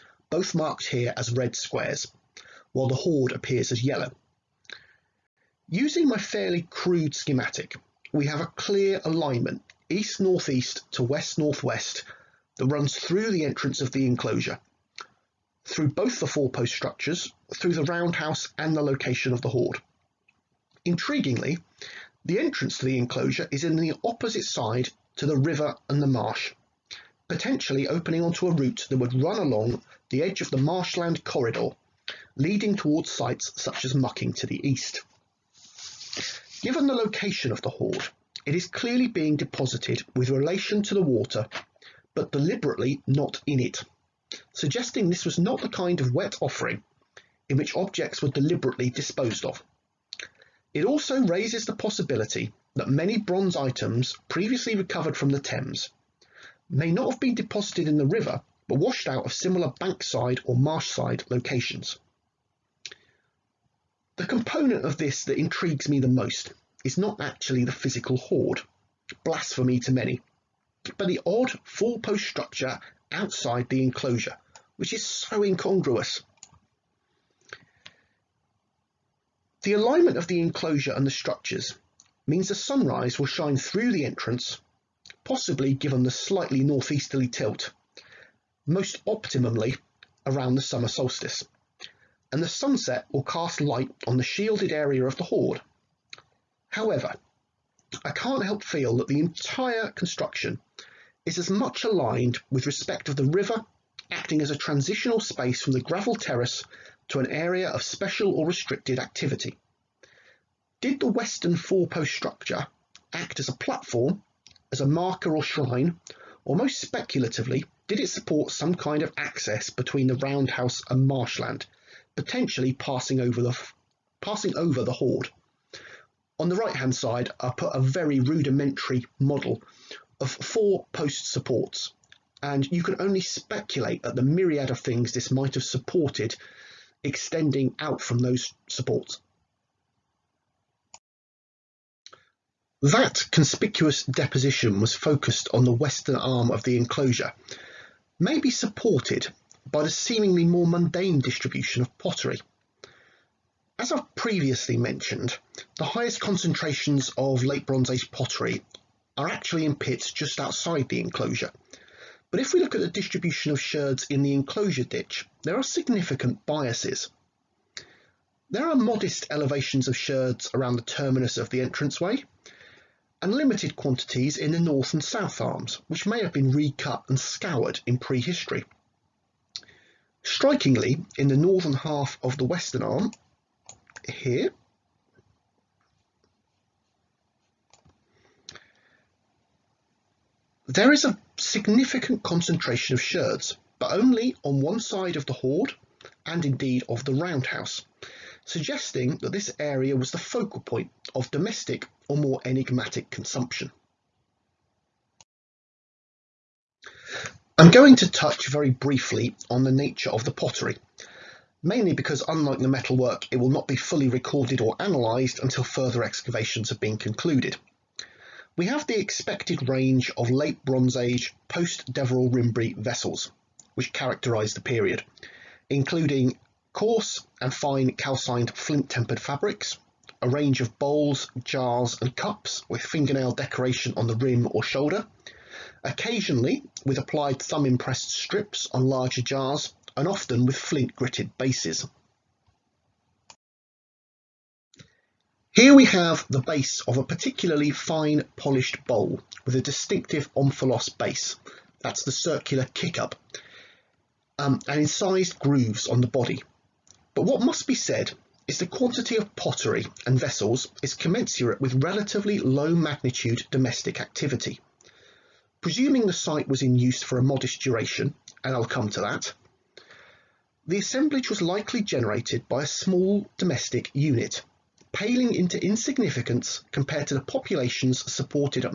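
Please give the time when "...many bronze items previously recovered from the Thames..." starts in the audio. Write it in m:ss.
0:52.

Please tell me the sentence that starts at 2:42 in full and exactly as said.
But if we look at the distribution of sherds in the enclosure ditch, there are significant biases.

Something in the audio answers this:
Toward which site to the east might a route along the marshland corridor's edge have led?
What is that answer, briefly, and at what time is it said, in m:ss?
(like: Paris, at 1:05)
Mucking, at 0:33.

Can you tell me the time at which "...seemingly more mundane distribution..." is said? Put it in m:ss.
2:29.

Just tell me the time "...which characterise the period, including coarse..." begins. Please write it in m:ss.
3:43.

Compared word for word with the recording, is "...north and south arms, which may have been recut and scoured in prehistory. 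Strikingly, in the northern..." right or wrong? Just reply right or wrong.
right.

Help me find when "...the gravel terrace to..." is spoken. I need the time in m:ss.
1:45.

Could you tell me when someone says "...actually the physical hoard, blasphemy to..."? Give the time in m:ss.
1:07.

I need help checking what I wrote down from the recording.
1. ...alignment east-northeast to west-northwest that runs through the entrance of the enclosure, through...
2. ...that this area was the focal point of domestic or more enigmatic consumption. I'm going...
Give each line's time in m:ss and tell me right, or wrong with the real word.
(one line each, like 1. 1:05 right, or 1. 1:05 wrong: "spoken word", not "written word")
1. 0:09 right
2. 3:19 right.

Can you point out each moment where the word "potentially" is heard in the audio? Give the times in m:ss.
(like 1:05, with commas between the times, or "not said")
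0:27, 2:02.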